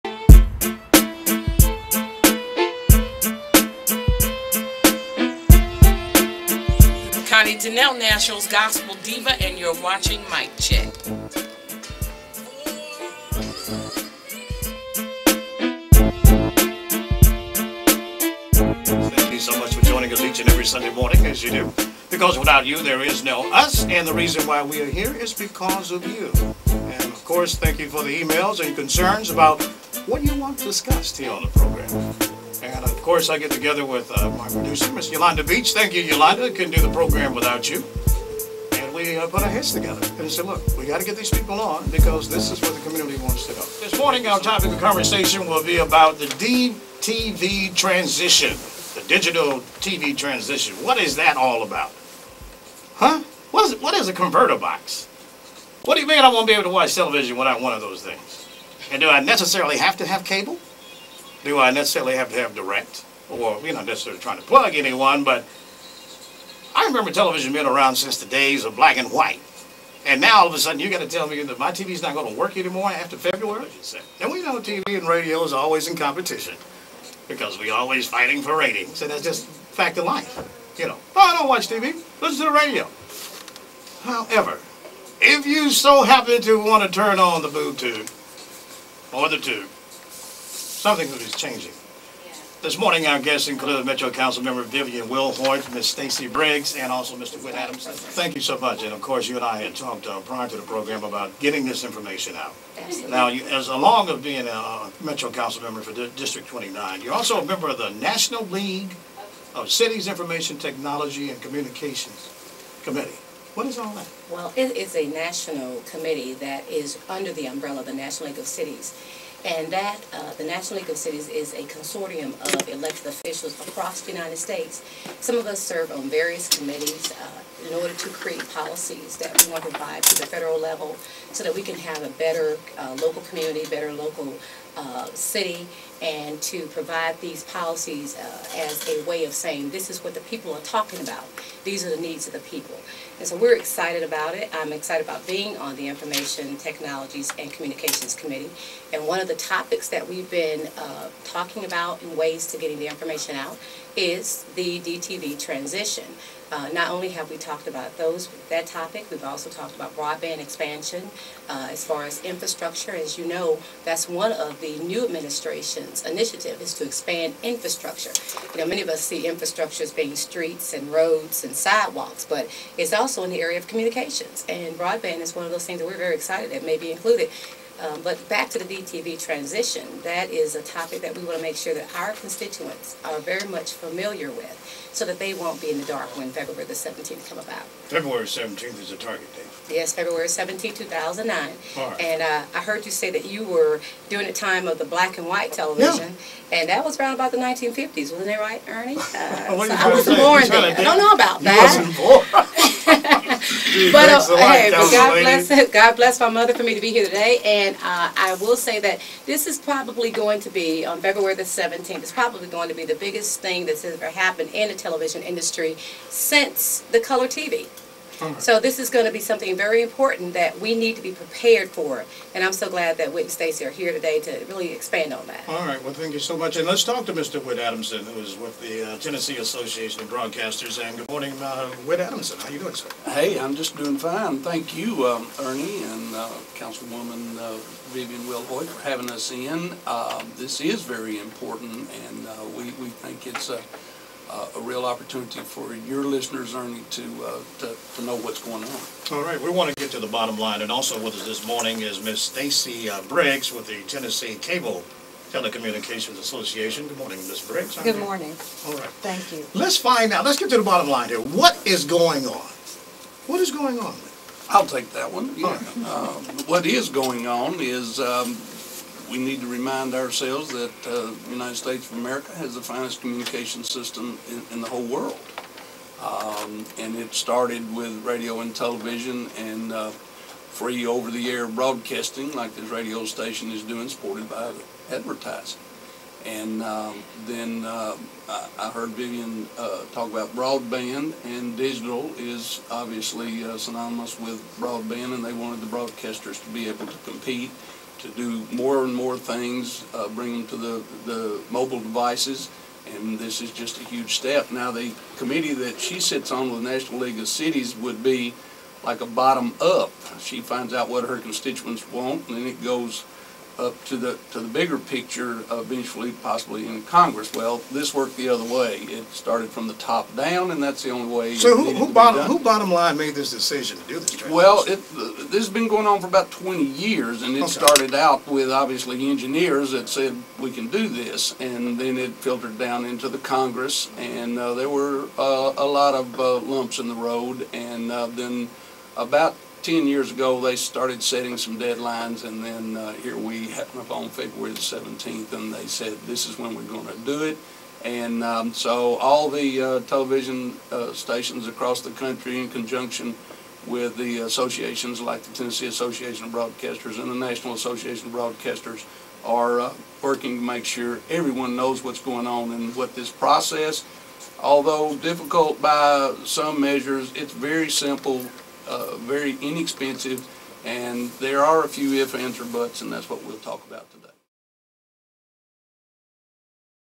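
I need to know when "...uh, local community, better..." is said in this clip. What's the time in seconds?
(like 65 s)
132 s.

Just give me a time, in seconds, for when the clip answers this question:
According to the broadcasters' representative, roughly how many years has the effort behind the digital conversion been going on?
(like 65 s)
326 s.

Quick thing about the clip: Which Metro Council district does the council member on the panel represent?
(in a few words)
District 29.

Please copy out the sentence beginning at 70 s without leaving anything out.
And now all of a sudden you got to tell me that my TV's not going to work anymore after February?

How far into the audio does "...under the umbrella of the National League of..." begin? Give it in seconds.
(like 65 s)
117 s.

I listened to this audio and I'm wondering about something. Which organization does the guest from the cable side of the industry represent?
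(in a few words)
Tennessee Cable Telecommunications Association.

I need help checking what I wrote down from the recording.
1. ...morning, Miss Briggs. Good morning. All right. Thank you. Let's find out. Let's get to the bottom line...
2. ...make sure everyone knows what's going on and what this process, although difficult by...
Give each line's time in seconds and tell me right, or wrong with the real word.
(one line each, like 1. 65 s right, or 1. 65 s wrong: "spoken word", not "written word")
1. 256 s right
2. 360 s right.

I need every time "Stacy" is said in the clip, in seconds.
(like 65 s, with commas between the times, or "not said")
95 s, 223 s, 252 s.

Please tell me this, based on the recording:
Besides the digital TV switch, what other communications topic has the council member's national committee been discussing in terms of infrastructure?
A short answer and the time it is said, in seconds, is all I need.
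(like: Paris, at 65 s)
Broadband expansion, at 159 s.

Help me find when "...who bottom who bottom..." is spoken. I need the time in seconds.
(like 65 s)
321 s.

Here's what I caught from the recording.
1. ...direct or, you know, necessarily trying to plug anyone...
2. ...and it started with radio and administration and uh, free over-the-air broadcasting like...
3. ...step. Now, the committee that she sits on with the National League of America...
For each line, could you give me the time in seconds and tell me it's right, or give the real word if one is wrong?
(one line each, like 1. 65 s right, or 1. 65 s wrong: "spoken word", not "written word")
1. 62 s right
2. 276 s wrong: "television", not "administration"
3. 304 s wrong: "Cities", not "America".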